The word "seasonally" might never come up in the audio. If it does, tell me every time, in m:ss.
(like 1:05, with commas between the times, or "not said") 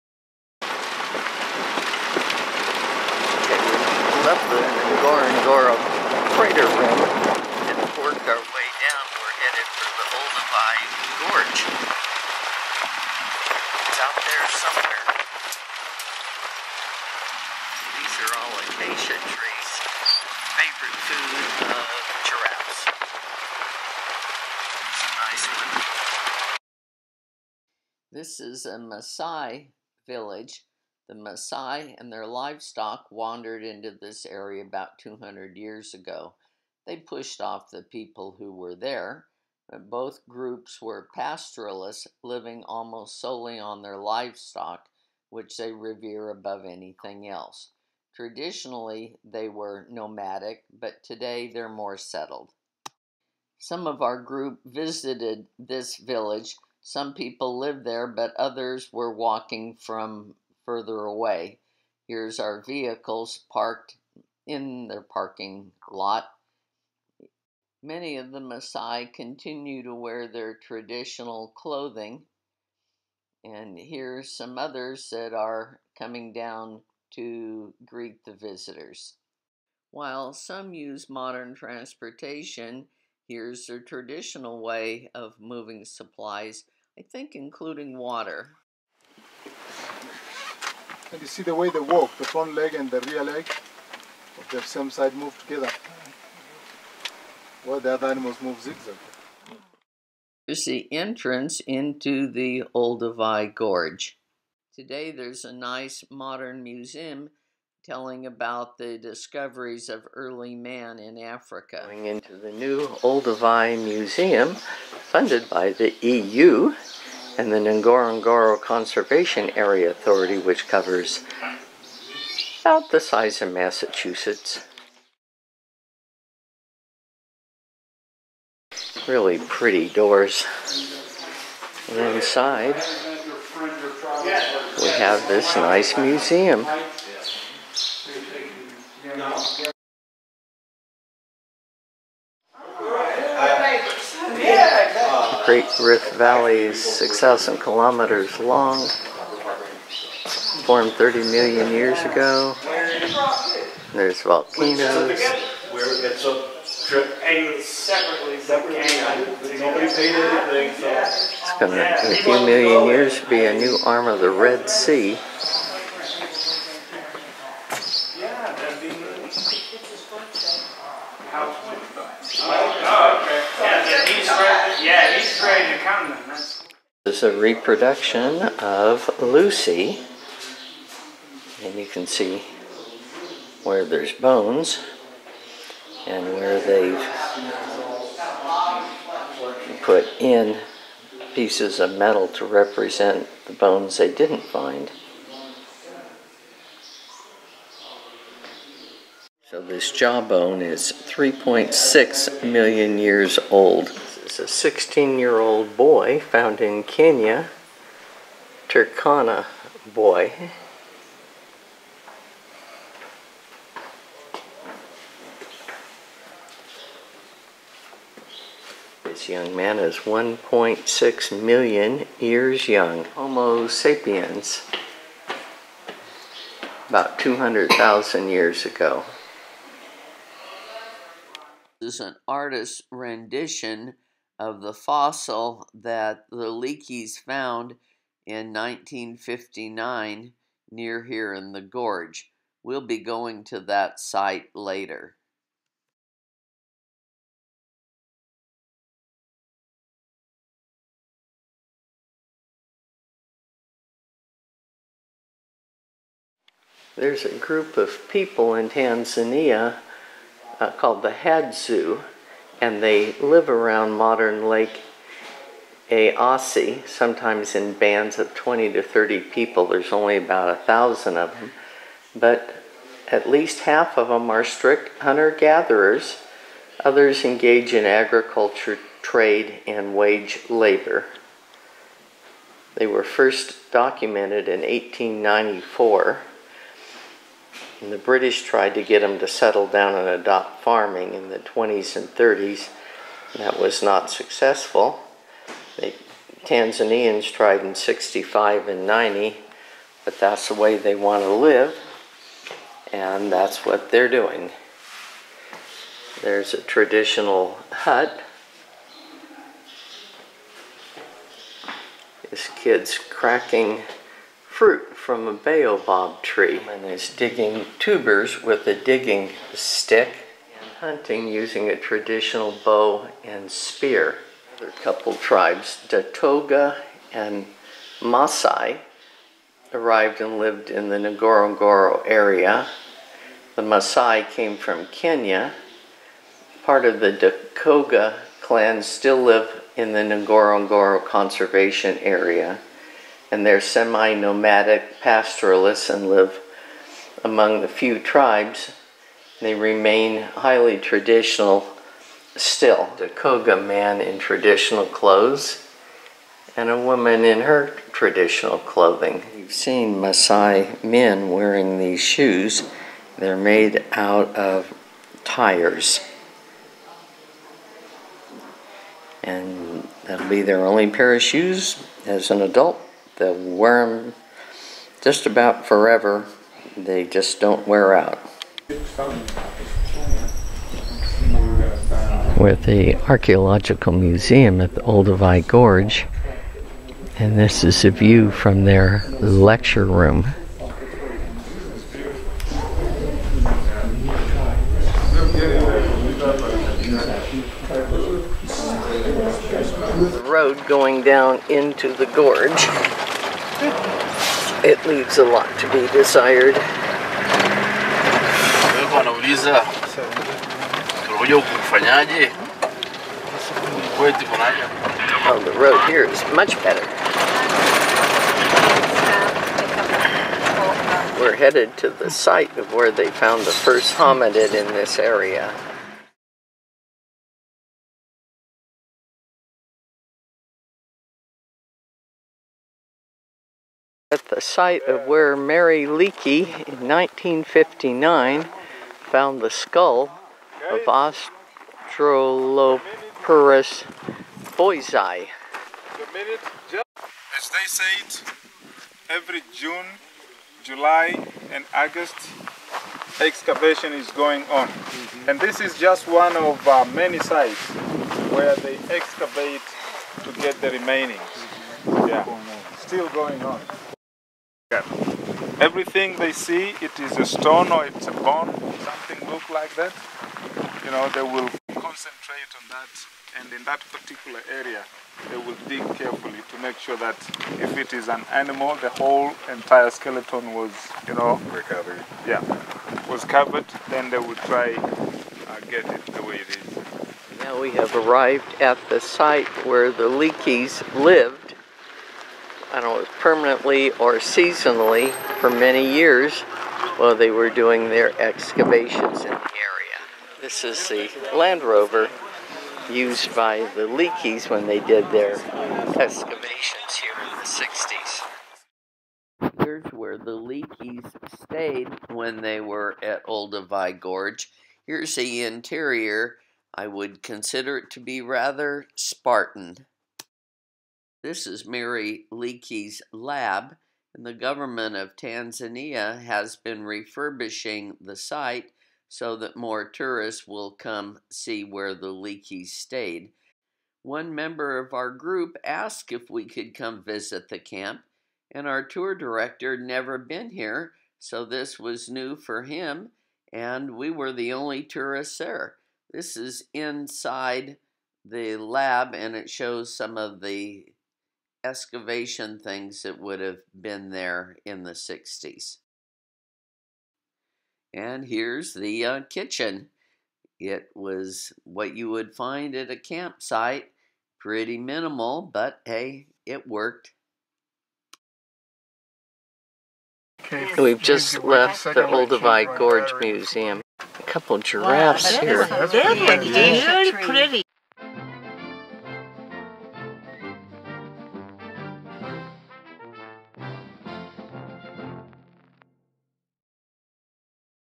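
8:14.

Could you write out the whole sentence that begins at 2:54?
Yeah, he's great this is a reproduction of Lucy.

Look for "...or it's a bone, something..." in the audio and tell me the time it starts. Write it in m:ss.
7:47.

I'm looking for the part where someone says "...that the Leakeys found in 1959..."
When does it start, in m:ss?
3:55.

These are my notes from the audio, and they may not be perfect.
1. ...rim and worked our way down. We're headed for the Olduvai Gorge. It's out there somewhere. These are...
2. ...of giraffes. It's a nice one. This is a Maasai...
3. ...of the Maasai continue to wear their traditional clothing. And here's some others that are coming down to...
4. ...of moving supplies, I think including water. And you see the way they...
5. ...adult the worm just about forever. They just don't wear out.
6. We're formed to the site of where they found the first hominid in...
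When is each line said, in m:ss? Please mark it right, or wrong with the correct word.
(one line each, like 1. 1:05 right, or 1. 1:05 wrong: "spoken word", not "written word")
1. 0:06 right
2. 0:21 right
3. 1:08 right
4. 1:25 right
5. 6:12 right
6. 7:01 wrong: "headed", not "formed".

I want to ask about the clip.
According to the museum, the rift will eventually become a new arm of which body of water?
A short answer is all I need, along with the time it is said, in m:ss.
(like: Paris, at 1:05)
Red Sea, at 2:44.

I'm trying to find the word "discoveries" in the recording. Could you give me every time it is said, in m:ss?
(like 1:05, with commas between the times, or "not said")
1:48.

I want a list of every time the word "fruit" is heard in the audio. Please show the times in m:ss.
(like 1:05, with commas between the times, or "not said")
5:14.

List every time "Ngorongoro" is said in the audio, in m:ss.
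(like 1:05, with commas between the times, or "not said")
0:05, 1:57, 5:30, 5:40.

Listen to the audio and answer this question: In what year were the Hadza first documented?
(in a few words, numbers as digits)
1894.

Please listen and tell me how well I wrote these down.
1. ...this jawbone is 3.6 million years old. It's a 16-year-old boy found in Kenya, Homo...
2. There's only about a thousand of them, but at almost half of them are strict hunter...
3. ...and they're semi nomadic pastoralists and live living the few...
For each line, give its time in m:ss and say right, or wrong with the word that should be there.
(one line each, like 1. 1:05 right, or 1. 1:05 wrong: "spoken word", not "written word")
1. 3:19 wrong: "Turkana", not "Homo"
2. 4:29 wrong: "least", not "almost"
3. 5:43 wrong: "among", not "living".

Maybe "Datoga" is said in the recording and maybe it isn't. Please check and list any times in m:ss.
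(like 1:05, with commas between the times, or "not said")
5:25, 5:37, 5:52.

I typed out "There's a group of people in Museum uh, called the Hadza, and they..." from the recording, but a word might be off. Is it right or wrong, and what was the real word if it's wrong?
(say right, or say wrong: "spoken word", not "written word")
wrong: "Tanzania", not "Museum".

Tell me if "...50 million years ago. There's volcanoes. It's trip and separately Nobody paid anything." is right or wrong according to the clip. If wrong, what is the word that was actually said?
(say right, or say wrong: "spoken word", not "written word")
wrong: "30", not "50".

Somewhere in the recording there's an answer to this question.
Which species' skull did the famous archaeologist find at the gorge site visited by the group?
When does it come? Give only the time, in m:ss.
7:21.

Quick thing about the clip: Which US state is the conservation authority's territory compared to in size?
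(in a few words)
Massachusetts.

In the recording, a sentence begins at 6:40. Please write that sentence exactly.
road going down into the gorge.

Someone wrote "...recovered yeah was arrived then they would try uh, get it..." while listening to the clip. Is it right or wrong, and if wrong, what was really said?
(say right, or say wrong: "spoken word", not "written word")
wrong: "covered", not "arrived".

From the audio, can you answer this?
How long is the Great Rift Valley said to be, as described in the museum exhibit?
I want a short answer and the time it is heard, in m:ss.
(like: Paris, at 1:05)
6,000 kilometers, at 2:26.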